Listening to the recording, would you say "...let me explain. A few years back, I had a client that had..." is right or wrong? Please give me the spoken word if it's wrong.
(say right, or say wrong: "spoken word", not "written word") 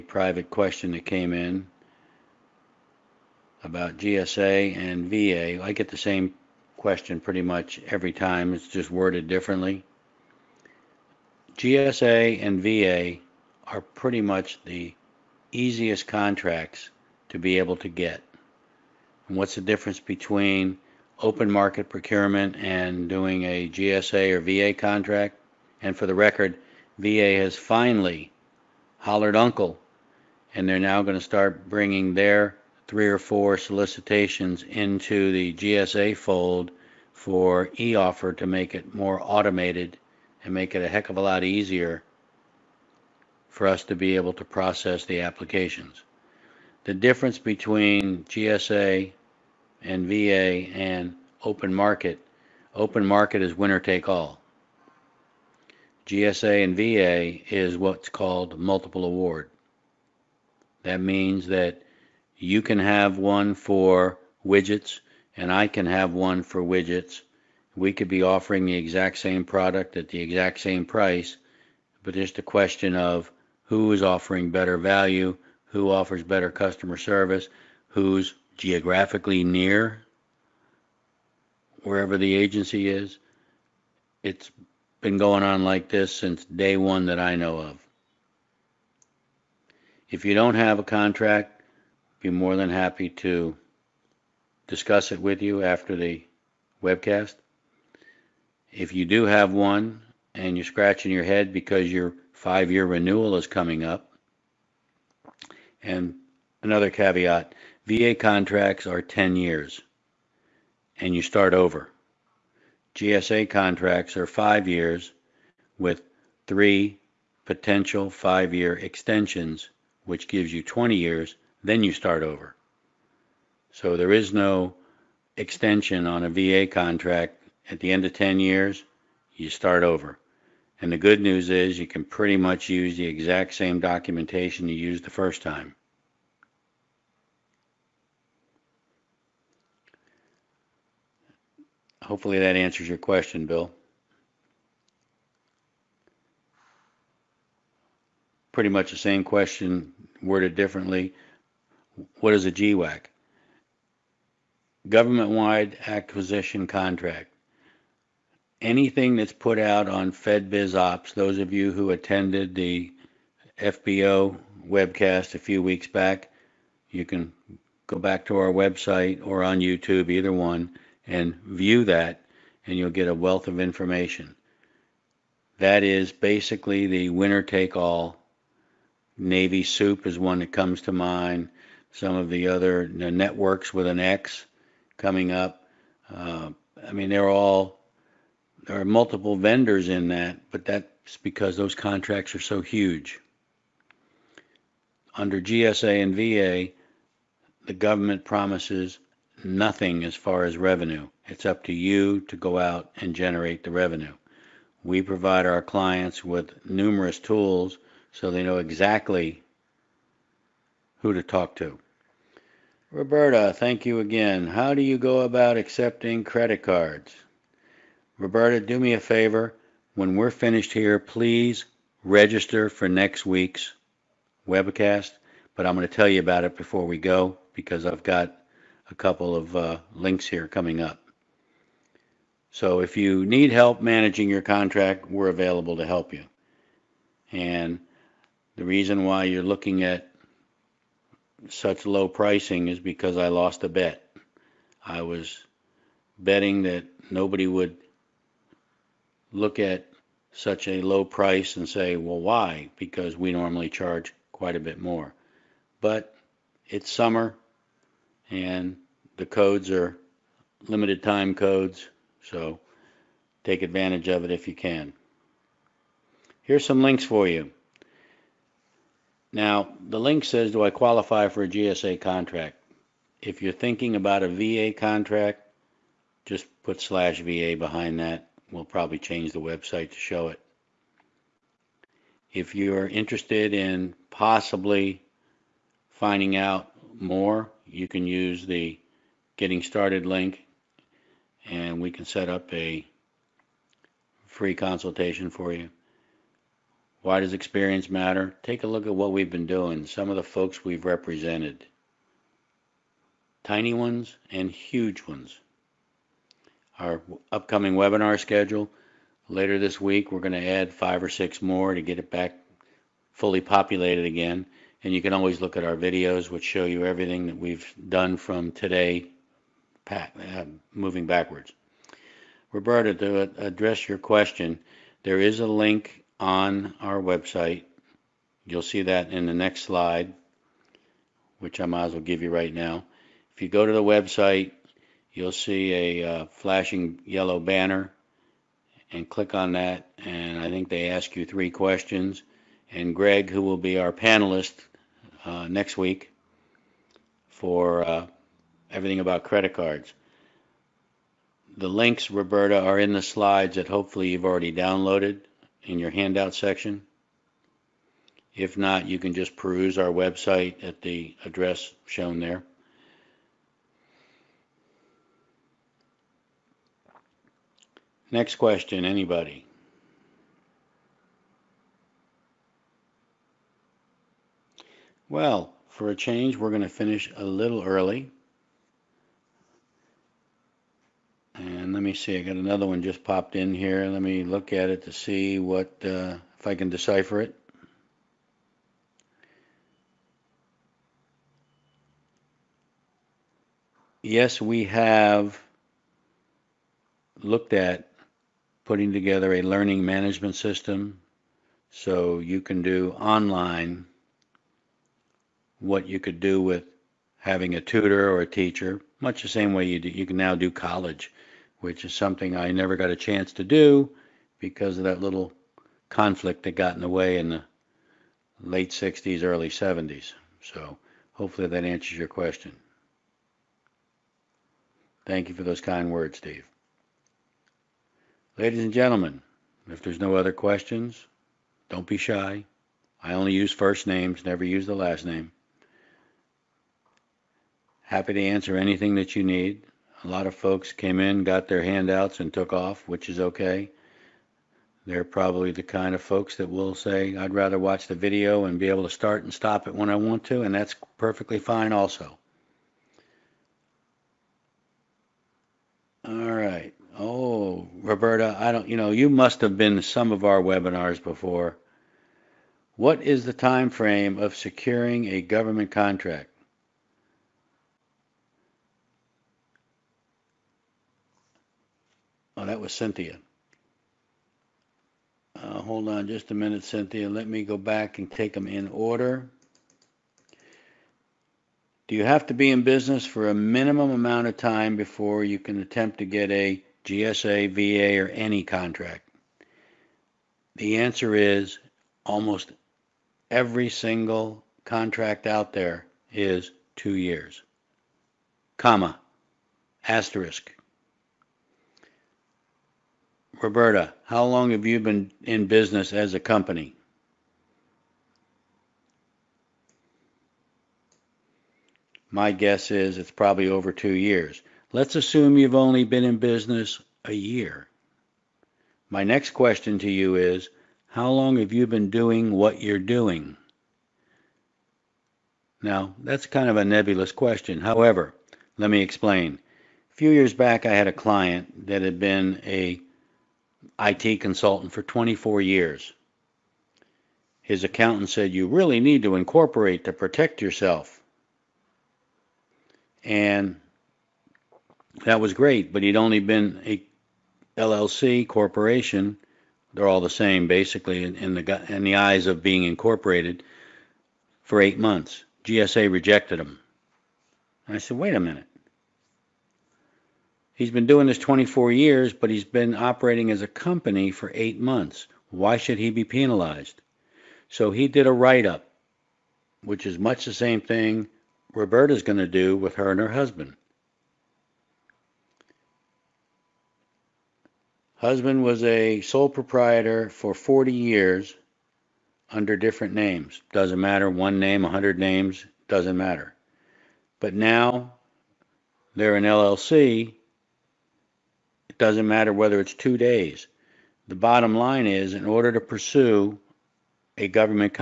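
right.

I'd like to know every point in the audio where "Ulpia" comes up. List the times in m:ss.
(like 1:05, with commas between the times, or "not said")
not said.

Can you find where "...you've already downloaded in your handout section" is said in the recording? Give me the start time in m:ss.
5:54.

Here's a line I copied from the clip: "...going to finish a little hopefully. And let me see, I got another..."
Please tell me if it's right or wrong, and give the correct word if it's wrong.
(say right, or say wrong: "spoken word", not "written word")
wrong: "early", not "hopefully".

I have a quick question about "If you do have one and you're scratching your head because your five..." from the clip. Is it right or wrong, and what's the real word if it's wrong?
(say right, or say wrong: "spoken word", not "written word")
right.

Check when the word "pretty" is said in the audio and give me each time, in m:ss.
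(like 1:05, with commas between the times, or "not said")
0:07, 0:13, 2:12, 2:28.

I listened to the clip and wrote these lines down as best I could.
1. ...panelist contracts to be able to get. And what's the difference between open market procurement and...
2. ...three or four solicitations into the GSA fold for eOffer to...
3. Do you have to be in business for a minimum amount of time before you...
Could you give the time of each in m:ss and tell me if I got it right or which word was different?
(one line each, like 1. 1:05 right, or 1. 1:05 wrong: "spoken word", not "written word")
1. 0:15 wrong: "easiest", not "panelist"
2. 0:32 right
3. 8:01 right.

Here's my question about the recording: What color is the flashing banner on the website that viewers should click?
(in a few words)
Yellow.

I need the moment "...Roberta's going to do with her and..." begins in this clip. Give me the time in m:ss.
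9:31.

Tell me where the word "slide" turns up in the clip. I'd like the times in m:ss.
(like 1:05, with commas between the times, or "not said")
5:29, 5:53.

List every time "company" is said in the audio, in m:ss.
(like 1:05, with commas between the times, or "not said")
8:26, 9:23.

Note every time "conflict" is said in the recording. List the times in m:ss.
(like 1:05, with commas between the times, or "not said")
6:55.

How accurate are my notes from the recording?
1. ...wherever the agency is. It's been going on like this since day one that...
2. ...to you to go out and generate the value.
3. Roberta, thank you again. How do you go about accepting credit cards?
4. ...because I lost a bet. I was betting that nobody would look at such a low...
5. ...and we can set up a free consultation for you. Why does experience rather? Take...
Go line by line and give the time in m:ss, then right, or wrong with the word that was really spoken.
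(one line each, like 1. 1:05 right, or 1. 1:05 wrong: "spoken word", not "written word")
1. 1:21 right
2. 3:21 wrong: "revenue", not "value"
3. 3:32 right
4. 4:02 right
5. 4:51 wrong: "matter", not "rather".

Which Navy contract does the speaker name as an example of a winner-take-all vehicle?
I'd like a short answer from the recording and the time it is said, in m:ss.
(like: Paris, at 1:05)
Navy soup, at 2:59.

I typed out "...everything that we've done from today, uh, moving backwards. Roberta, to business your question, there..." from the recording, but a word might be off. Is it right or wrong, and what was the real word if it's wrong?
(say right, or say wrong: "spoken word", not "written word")
wrong: "address", not "business".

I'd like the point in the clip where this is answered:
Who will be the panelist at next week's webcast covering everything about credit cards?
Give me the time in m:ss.
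5:42.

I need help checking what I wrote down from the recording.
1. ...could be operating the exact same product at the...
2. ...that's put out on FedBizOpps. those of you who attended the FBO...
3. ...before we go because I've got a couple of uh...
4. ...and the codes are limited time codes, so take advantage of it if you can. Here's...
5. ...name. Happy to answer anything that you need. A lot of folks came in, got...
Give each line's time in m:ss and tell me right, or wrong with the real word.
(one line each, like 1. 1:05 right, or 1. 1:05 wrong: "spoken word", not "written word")
1. 1:07 wrong: "offering", not "operating"
2. 2:39 right
3. 3:46 right
4. 4:18 right
5. 7:15 right.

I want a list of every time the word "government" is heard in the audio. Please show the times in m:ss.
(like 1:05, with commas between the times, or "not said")
2:34, 3:17, 7:45, 9:57.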